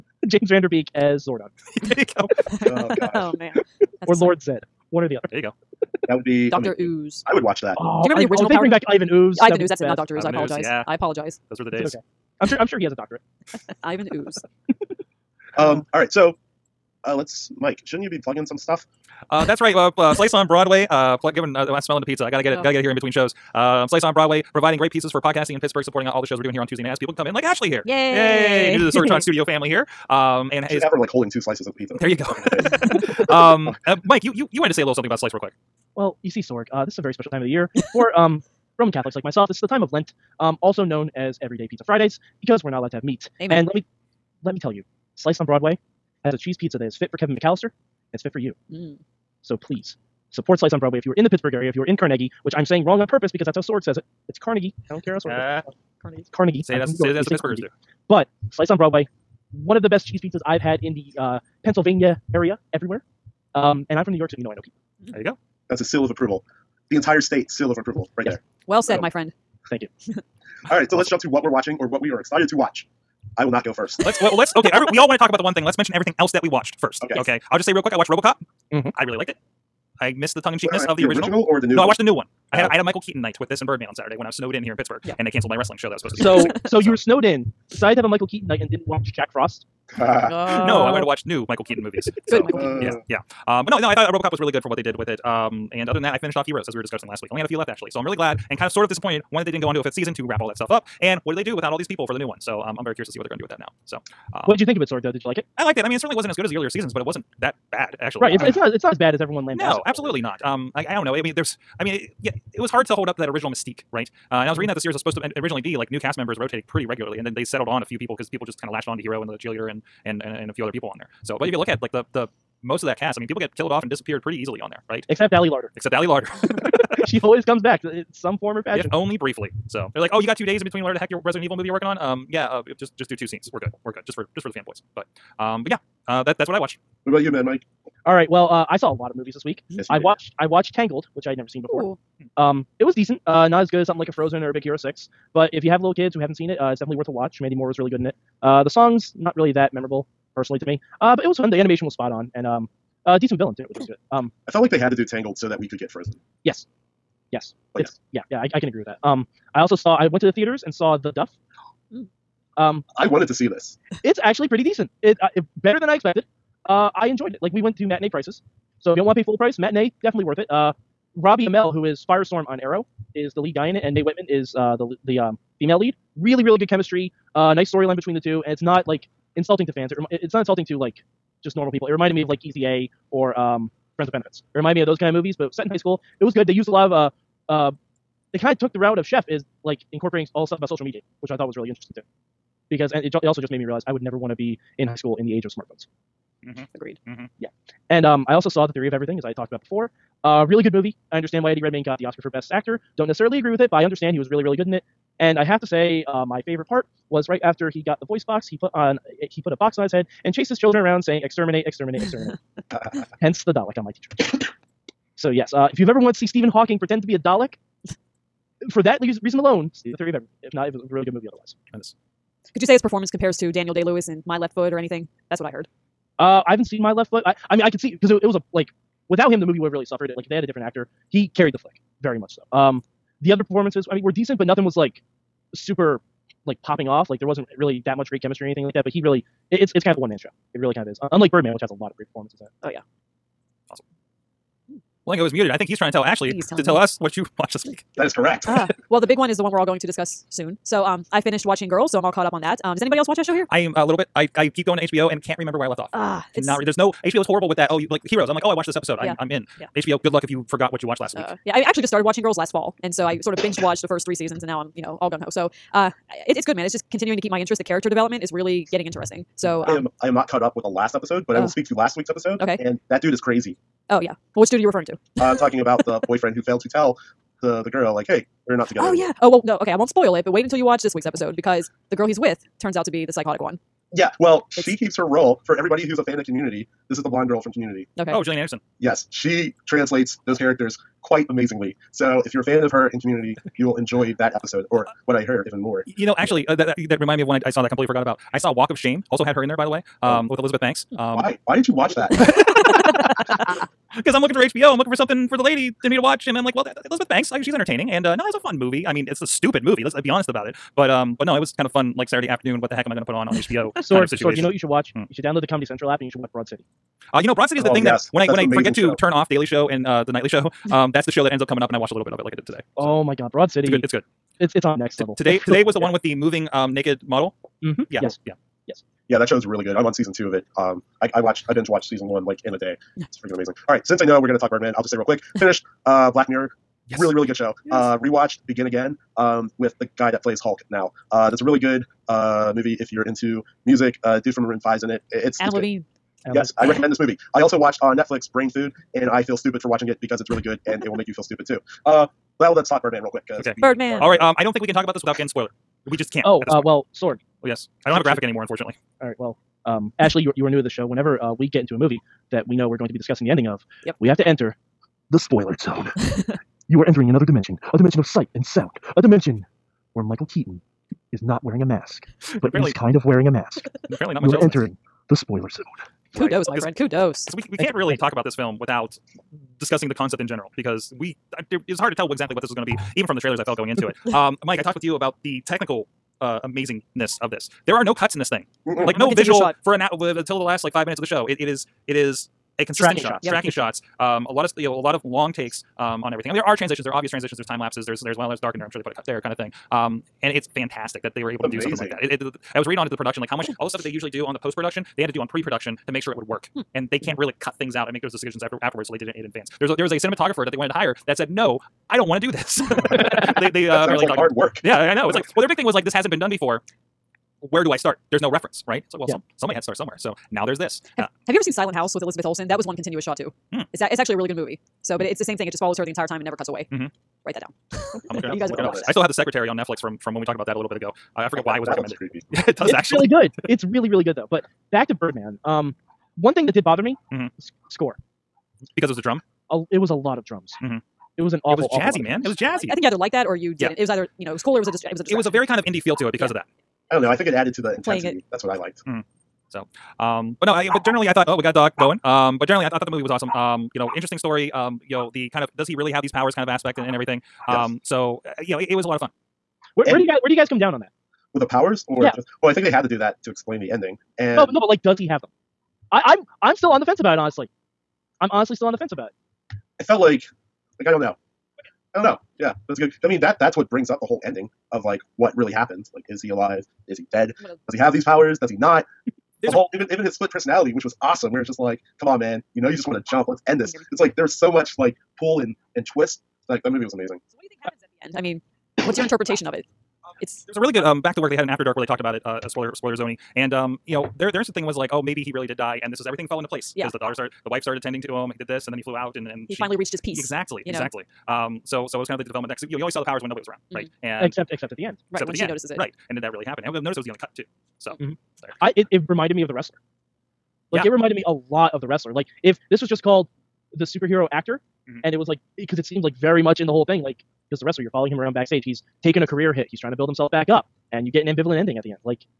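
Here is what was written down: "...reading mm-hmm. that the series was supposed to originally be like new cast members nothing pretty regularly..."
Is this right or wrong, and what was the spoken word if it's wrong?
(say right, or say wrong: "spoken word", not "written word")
wrong: "rotating", not "nothing".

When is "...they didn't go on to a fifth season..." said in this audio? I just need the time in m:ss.
1:39.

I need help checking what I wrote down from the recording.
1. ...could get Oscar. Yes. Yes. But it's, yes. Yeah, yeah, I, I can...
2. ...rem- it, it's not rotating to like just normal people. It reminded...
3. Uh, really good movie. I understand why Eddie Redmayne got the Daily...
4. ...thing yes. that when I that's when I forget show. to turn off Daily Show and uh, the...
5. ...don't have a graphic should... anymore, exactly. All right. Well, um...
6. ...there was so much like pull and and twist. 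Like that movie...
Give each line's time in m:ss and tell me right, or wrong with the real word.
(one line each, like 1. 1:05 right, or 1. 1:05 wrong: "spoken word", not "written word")
1. 2:35 wrong: "Frozen", not "Oscar"
2. 2:59 wrong: "insulting", not "rotating"
3. 3:20 wrong: "Oscar", not "Daily"
4. 5:17 right
5. 5:57 wrong: "unfortunately", not "exactly"
6. 8:04 right.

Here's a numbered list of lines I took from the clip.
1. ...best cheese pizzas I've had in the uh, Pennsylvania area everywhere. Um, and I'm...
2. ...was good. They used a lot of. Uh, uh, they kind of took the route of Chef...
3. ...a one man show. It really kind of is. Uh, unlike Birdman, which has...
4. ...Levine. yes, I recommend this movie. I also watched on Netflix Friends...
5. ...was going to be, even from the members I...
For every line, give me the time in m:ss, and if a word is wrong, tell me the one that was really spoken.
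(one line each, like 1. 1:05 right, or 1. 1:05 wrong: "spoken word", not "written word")
1. 0:59 right
2. 3:06 right
3. 3:59 right
4. 5:45 wrong: "Brain", not "Friends"
5. 6:22 wrong: "trailers", not "members".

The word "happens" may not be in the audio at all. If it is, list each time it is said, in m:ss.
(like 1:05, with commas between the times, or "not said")
7:55, 8:07, 8:26.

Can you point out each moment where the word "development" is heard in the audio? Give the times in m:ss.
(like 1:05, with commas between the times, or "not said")
4:27, 8:22.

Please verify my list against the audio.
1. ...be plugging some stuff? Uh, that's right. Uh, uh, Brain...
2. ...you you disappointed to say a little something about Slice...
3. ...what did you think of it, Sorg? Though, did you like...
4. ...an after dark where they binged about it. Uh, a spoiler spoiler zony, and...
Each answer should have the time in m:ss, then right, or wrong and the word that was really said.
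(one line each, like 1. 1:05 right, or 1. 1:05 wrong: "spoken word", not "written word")
1. 0:18 wrong: "Slice", not "Brain"
2. 0:34 wrong: "wanted", not "disappointed"
3. 1:44 right
4. 8:11 wrong: "talked", not "binged".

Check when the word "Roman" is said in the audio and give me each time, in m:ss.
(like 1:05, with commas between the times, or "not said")
0:38.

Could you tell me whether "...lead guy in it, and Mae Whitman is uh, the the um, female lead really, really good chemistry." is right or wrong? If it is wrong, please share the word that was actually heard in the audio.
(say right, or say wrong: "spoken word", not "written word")
right.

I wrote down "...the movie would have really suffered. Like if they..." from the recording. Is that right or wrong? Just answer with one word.
right.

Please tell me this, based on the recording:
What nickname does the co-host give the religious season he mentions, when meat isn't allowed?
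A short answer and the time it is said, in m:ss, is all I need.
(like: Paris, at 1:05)
Everyday Pizza Fridays, at 0:41.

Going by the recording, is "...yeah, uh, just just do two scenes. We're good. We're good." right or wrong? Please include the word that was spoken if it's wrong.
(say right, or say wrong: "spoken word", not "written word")
right.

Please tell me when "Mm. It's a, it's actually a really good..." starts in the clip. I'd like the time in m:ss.
7:03.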